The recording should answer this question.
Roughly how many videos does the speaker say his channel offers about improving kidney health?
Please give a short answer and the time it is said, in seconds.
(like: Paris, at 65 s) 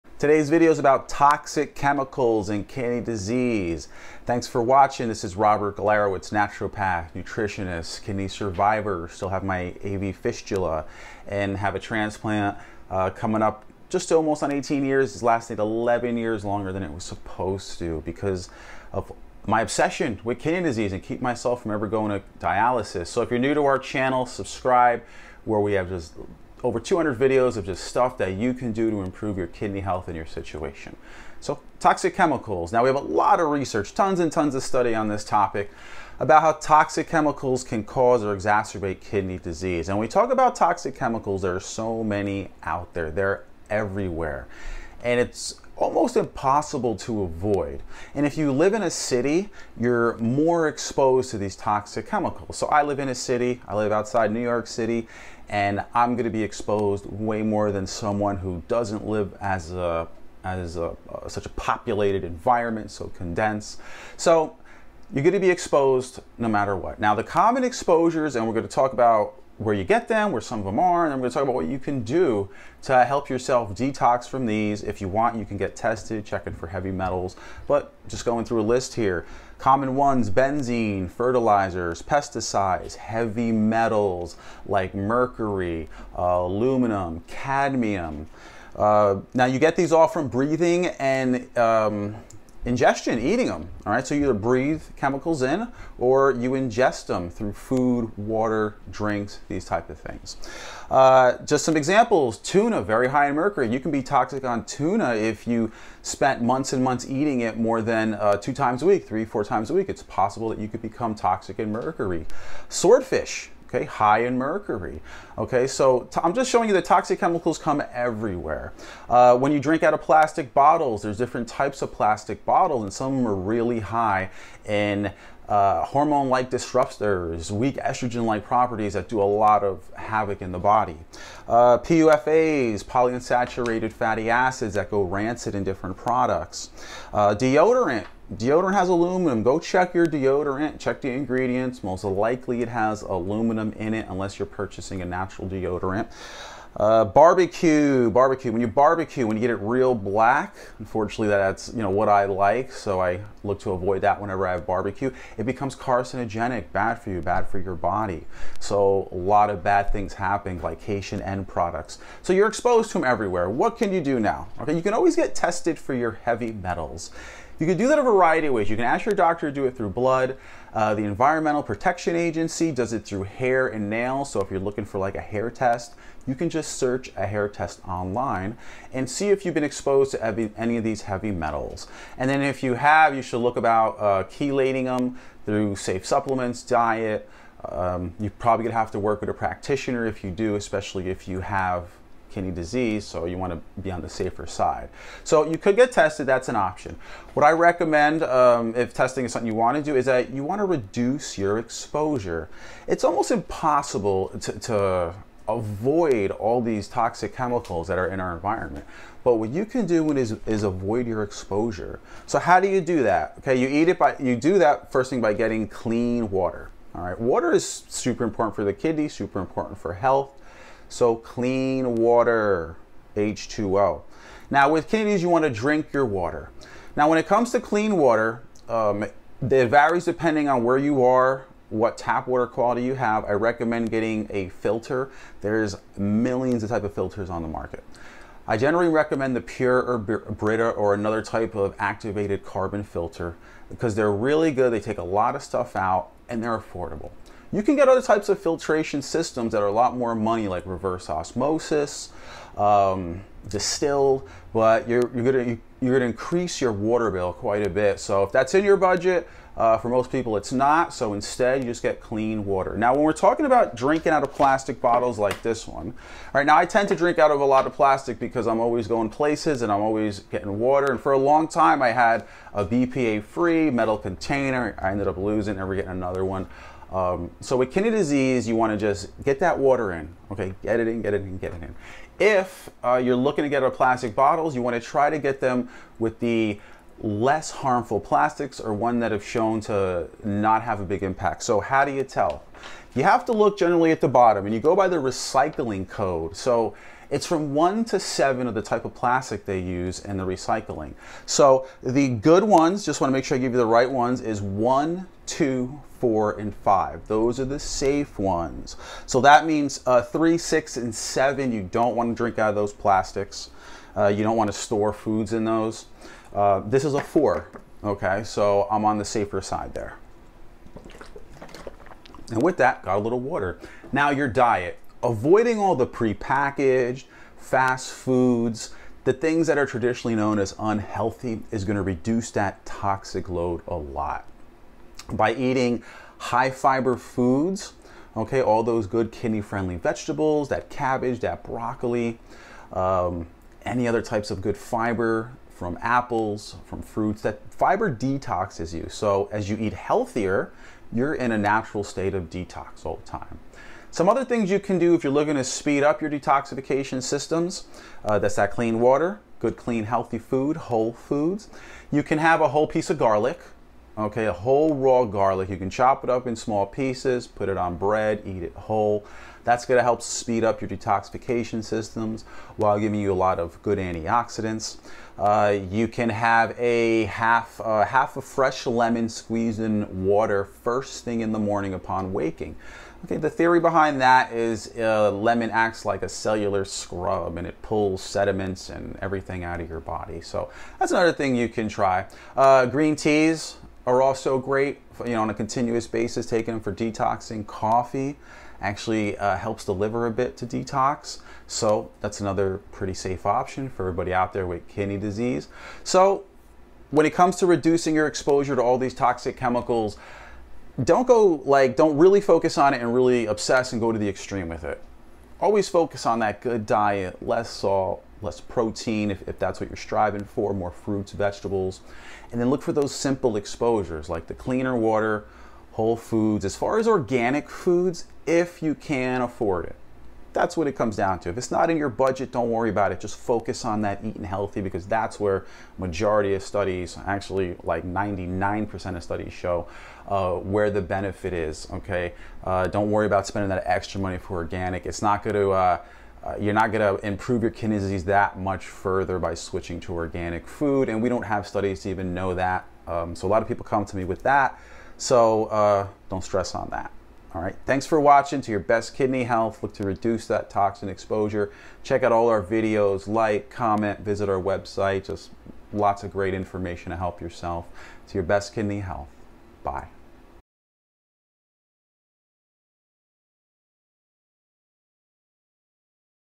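200, at 25 s.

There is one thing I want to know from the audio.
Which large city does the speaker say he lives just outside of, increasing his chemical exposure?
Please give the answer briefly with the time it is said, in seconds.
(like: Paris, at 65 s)
New York City, at 54 s.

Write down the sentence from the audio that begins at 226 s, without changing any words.
Now when it comes to clean water, um, it varies depending on where you are, what tap water quality you have.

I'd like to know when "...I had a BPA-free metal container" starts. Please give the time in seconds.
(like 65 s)
271 s.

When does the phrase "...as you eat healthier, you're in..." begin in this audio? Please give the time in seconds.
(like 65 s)
349 s.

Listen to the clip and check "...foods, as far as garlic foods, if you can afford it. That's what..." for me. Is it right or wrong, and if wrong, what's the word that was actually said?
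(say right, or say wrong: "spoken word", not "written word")
wrong: "organic", not "garlic".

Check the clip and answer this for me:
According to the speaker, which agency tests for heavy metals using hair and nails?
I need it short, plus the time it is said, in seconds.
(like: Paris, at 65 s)
Environmental Protection Agency, at 171 s.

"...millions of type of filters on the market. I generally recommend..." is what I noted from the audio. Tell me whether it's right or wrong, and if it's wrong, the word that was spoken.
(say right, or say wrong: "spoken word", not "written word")
right.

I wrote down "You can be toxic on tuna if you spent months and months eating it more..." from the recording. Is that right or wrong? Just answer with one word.
right.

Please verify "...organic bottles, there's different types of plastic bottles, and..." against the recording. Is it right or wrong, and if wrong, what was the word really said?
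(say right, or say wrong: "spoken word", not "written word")
wrong: "plastic", not "organic".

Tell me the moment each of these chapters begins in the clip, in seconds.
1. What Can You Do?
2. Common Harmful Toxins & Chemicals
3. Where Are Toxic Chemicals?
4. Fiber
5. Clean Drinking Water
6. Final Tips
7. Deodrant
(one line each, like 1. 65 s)
1. 161 s
2. 80 s
3. 40 s
4. 335 s
5. 229 s
6. 407 s
7. 136 s.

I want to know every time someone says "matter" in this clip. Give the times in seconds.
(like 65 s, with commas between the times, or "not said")
66 s.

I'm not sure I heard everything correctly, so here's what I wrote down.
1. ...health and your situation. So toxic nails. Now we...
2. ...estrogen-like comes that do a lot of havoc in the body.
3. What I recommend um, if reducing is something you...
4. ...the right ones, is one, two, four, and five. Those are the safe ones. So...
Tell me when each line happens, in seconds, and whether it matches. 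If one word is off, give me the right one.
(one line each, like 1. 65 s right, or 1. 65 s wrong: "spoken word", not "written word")
1. 29 s wrong: "chemicals", not "nails"
2. 127 s wrong: "properties", not "comes"
3. 197 s wrong: "testing", not "reducing"
4. 303 s right.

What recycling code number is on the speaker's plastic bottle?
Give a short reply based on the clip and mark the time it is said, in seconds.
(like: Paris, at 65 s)
4, at 316 s.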